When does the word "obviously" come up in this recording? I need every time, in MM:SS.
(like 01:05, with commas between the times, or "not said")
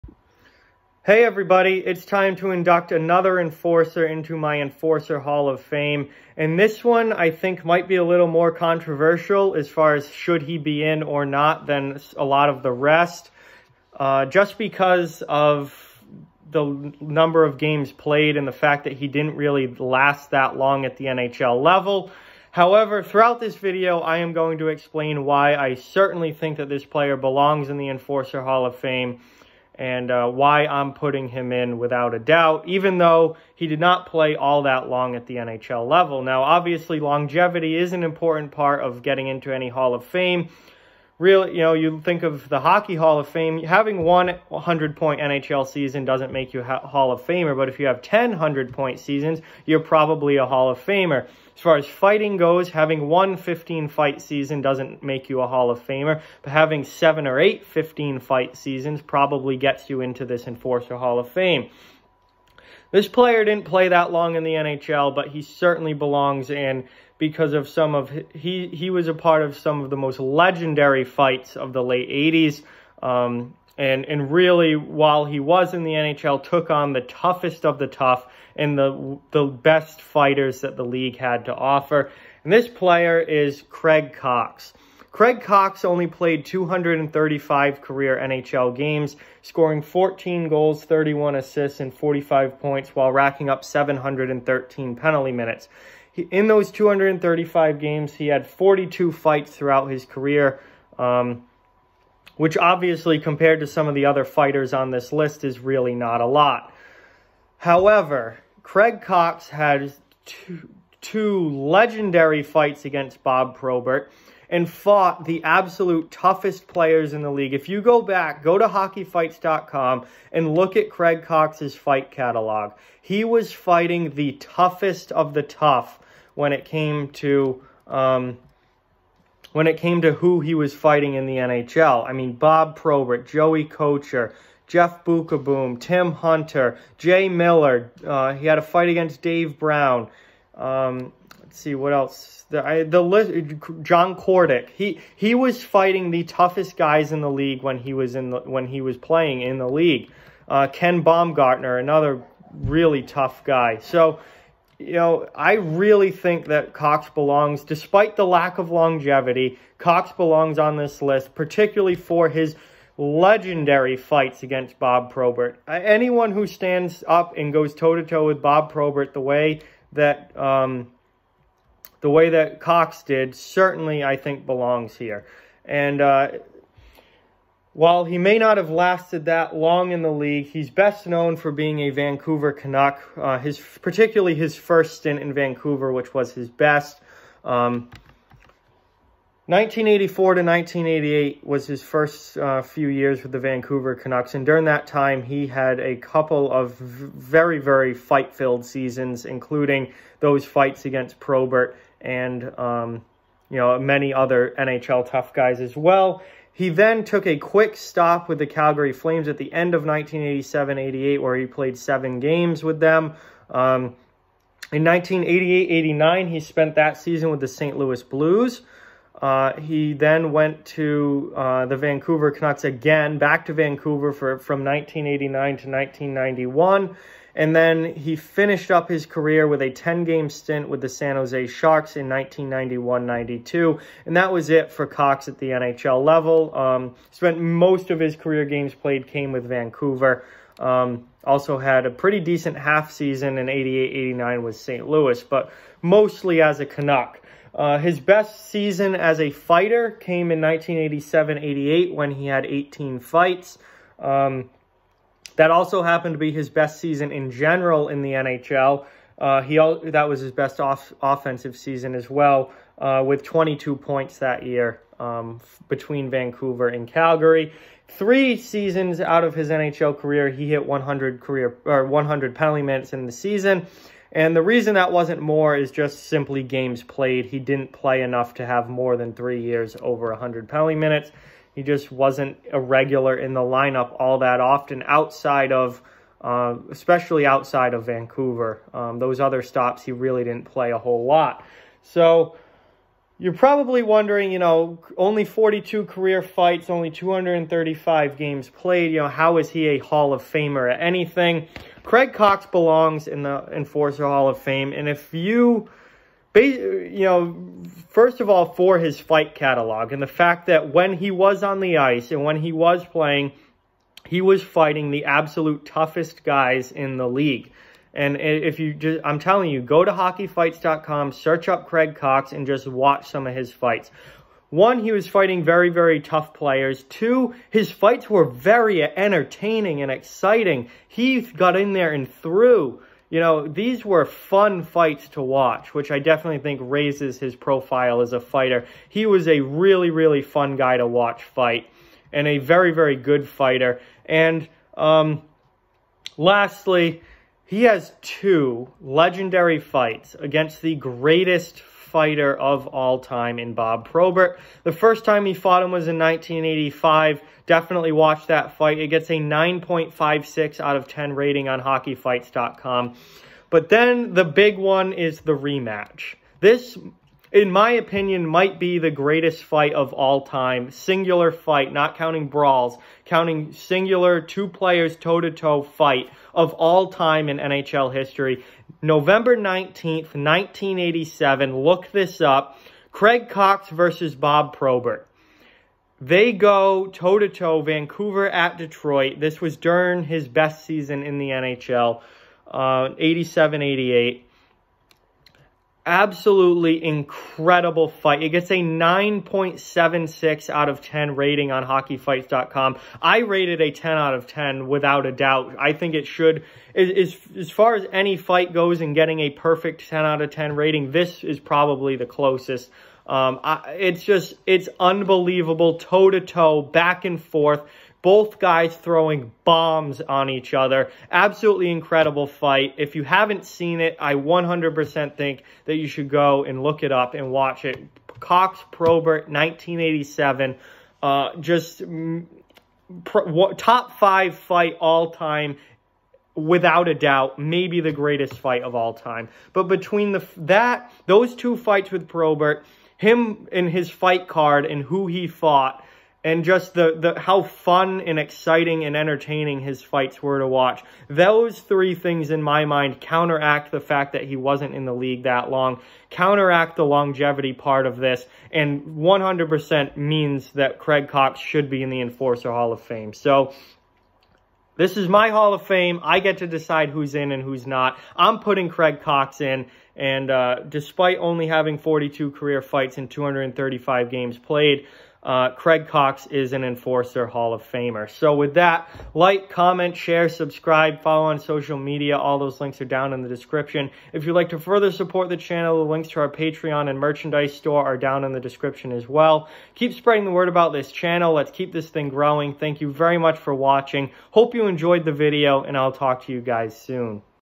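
00:36, 01:42.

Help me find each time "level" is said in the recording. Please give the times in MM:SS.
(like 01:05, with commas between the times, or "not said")
00:21, 00:35, 03:56.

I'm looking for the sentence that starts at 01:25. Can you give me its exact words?
Craig Coxe only played 235 career NHL games, scoring 14 goals, 31 assists, and 45 points while racking up 713 penalty minutes.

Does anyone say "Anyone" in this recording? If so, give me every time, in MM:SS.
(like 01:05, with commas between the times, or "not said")
02:45.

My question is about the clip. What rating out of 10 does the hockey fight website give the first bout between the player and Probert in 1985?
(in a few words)
9.56.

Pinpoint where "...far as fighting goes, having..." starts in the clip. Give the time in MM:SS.
00:51.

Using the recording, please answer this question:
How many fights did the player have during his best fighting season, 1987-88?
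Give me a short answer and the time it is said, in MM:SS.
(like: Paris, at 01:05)
18, at 04:12.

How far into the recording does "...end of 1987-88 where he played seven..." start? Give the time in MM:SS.
03:29.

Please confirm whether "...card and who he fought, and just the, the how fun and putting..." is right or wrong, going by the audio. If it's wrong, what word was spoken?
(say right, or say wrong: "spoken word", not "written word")
wrong: "exciting", not "putting".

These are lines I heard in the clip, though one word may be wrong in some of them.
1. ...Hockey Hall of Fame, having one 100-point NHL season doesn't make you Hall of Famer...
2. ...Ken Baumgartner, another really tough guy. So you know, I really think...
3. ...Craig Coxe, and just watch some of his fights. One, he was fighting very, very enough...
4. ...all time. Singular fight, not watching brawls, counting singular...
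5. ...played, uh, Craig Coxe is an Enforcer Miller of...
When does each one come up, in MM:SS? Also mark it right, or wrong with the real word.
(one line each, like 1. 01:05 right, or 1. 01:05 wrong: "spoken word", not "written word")
1. 00:42 right
2. 02:30 right
3. 05:21 wrong: "tough", not "enough"
4. 06:09 wrong: "counting", not "watching"
5. 07:54 wrong: "Hall", not "Miller".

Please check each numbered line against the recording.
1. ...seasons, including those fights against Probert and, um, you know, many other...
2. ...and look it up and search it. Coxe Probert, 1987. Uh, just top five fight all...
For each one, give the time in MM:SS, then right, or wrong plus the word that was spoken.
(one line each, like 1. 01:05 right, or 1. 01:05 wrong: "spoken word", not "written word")
1. 03:18 right
2. 07:06 wrong: "watch", not "search".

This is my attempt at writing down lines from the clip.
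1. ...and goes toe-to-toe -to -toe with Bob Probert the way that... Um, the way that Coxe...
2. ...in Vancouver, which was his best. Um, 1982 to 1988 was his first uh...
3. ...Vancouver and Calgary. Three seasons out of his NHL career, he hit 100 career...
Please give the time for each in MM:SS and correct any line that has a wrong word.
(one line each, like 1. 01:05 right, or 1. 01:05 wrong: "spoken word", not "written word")
1. 02:47 right
2. 03:05 wrong: "1984", not "1982"
3. 04:26 right.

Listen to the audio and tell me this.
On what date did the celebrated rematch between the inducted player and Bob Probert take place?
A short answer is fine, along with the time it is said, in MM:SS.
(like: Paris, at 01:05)
November 19, 1987, at 06:18.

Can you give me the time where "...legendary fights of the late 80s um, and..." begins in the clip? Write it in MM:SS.
01:10.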